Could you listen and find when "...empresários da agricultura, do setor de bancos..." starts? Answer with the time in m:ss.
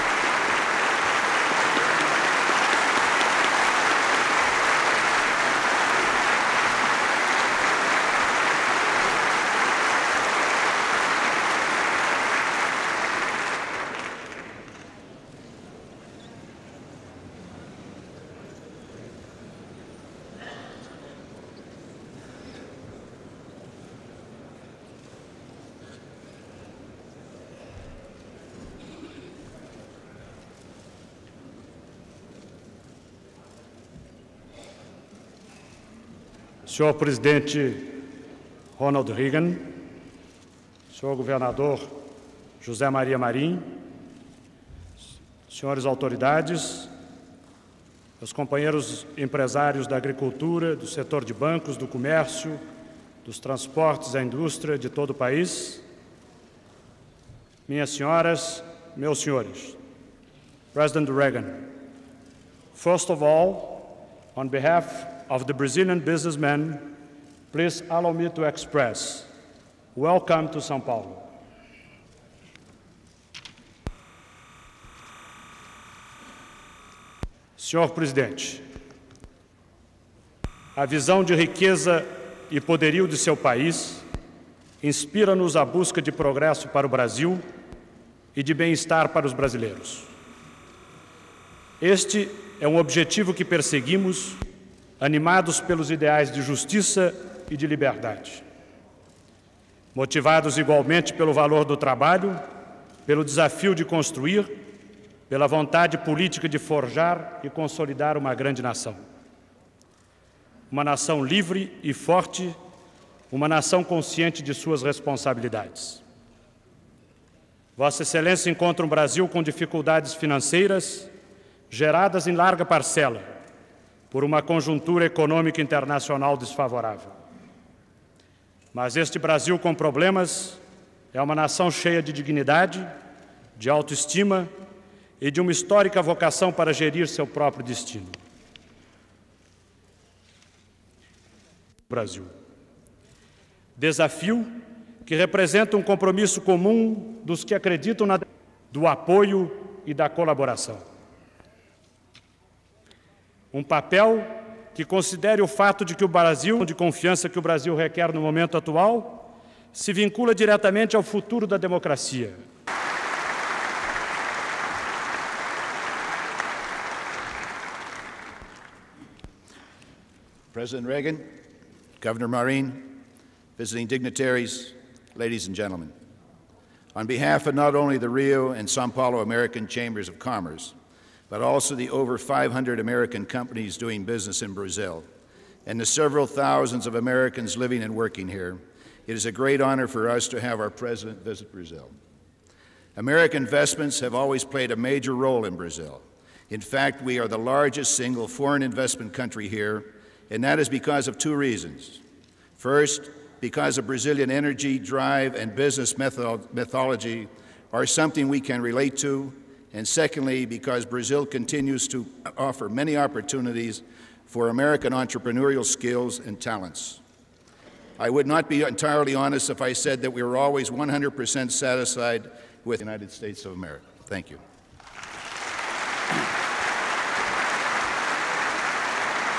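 0:49.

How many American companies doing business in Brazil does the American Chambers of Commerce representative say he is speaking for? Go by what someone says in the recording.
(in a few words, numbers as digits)
Over 500.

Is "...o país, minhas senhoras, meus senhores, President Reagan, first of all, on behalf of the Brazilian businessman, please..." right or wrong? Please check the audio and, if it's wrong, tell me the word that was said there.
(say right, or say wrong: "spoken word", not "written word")
right.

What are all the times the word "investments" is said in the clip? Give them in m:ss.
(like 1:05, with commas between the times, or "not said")
3:13, 3:18.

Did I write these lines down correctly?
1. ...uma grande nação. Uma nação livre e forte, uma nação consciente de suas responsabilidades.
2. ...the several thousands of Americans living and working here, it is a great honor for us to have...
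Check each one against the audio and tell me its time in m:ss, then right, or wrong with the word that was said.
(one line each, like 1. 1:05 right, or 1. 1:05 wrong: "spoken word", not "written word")
1. 1:48 right
2. 3:05 right.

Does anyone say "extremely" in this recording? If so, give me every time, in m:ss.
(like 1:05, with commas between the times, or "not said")
not said.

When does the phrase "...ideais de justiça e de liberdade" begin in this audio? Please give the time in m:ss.
1:35.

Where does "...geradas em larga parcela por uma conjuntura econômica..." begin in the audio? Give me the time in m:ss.
2:01.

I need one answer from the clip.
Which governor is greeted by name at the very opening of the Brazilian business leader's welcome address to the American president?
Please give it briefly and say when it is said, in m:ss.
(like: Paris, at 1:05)
José Maria Marim, at 0:42.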